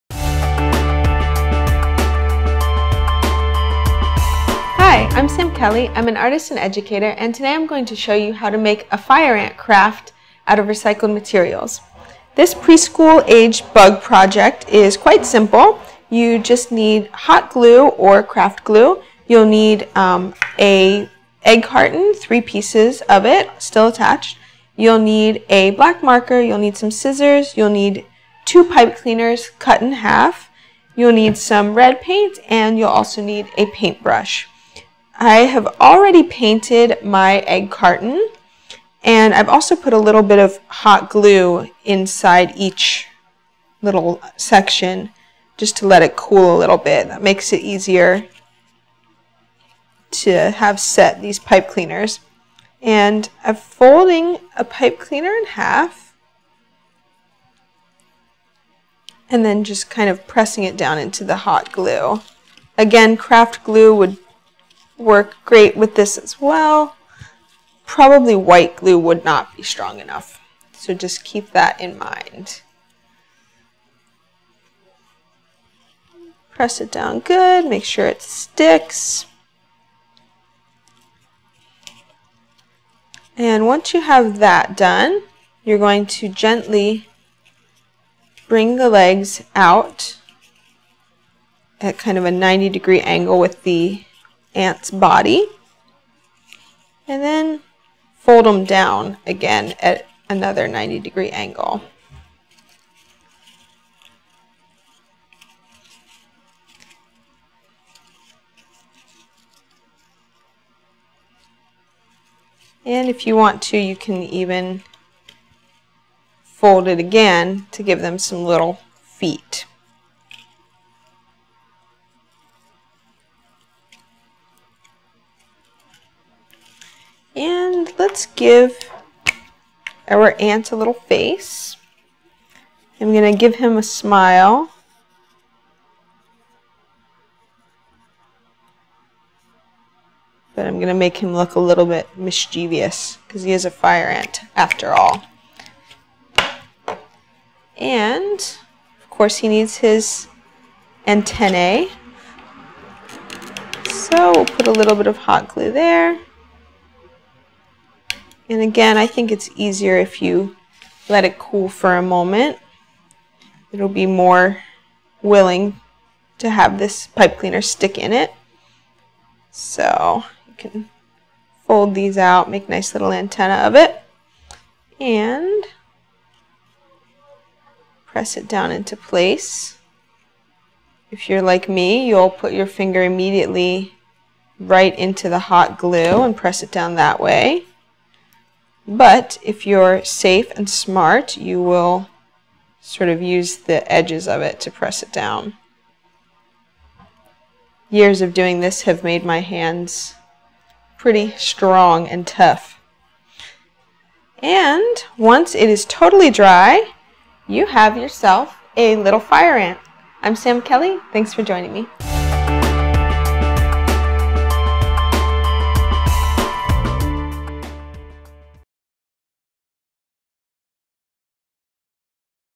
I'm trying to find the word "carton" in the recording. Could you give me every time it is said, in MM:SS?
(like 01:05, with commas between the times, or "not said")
00:21, 00:37.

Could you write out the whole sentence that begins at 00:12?
This preschool age bug project is quite simple.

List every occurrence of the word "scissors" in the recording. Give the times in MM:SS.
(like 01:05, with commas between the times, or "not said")
00:26.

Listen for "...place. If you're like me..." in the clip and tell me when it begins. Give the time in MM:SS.
02:58.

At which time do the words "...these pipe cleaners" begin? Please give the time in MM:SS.
00:51.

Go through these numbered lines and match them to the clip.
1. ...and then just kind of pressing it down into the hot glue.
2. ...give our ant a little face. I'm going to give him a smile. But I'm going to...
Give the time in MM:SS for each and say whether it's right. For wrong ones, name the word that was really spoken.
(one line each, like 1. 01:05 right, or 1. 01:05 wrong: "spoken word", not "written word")
1. 00:59 right
2. 02:08 right.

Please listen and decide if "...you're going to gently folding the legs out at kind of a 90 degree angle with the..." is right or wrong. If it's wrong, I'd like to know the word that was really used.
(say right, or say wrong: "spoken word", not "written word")
wrong: "bring", not "folding".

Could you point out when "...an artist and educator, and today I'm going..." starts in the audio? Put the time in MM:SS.
00:06.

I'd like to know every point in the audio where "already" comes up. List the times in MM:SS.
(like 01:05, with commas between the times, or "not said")
00:35.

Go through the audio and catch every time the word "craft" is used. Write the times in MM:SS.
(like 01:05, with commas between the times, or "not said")
00:09, 00:18, 01:03.